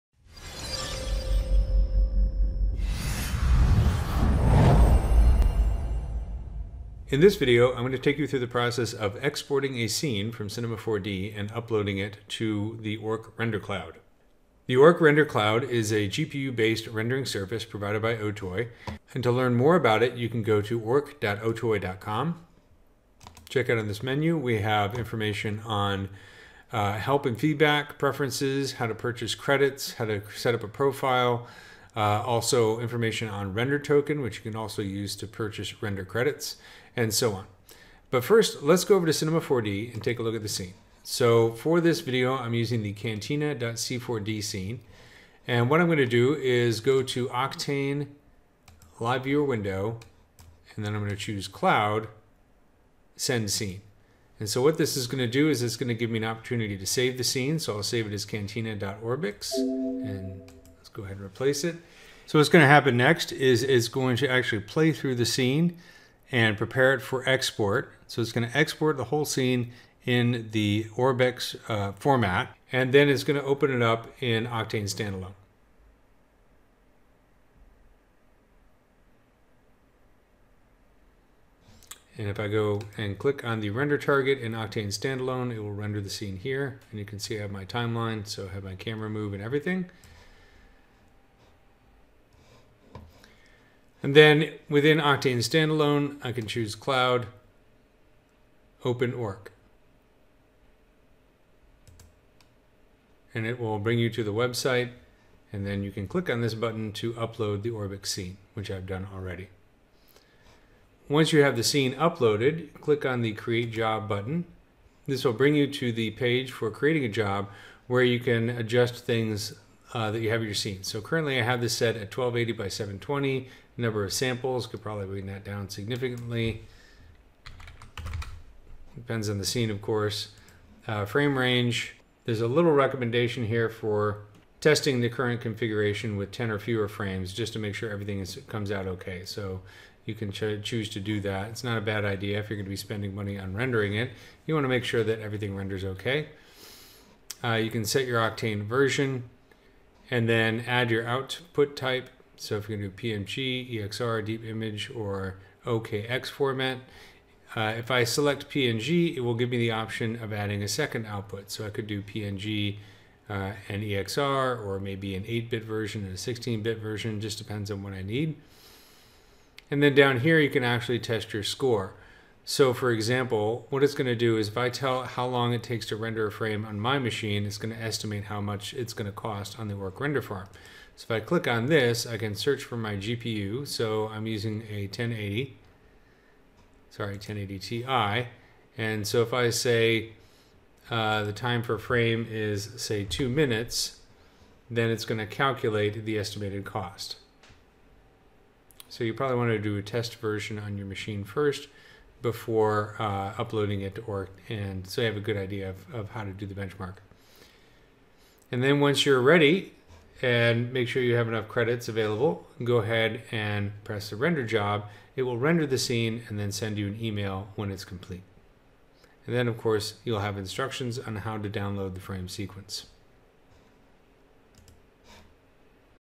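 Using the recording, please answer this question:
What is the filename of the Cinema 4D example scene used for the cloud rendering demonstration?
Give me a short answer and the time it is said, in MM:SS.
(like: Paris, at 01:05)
cantina.c4d, at 00:42.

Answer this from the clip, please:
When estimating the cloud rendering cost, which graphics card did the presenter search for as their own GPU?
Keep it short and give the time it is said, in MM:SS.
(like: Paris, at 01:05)
1080 Ti, at 03:07.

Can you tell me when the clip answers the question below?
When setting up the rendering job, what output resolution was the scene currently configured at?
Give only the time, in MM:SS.
02:02.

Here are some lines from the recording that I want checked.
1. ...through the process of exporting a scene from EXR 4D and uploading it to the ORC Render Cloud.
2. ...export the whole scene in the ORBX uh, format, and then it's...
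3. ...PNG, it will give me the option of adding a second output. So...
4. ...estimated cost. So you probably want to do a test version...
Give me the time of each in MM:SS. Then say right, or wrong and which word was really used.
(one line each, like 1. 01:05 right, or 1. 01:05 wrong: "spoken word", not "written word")
1. 00:08 wrong: "Cinema", not "EXR"
2. 01:08 right
3. 02:38 right
4. 03:16 right.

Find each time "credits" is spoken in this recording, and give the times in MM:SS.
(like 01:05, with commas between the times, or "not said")
00:29, 00:36, 03:31.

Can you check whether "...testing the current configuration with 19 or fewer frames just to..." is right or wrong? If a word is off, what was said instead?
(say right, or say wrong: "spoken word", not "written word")
wrong: "10", not "19".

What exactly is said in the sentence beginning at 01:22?
And if I go and click on the render target in Octane Standalone, it will render the scene here.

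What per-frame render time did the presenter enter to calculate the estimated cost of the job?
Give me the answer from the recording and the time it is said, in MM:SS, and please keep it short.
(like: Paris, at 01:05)
2 minutes, at 03:13.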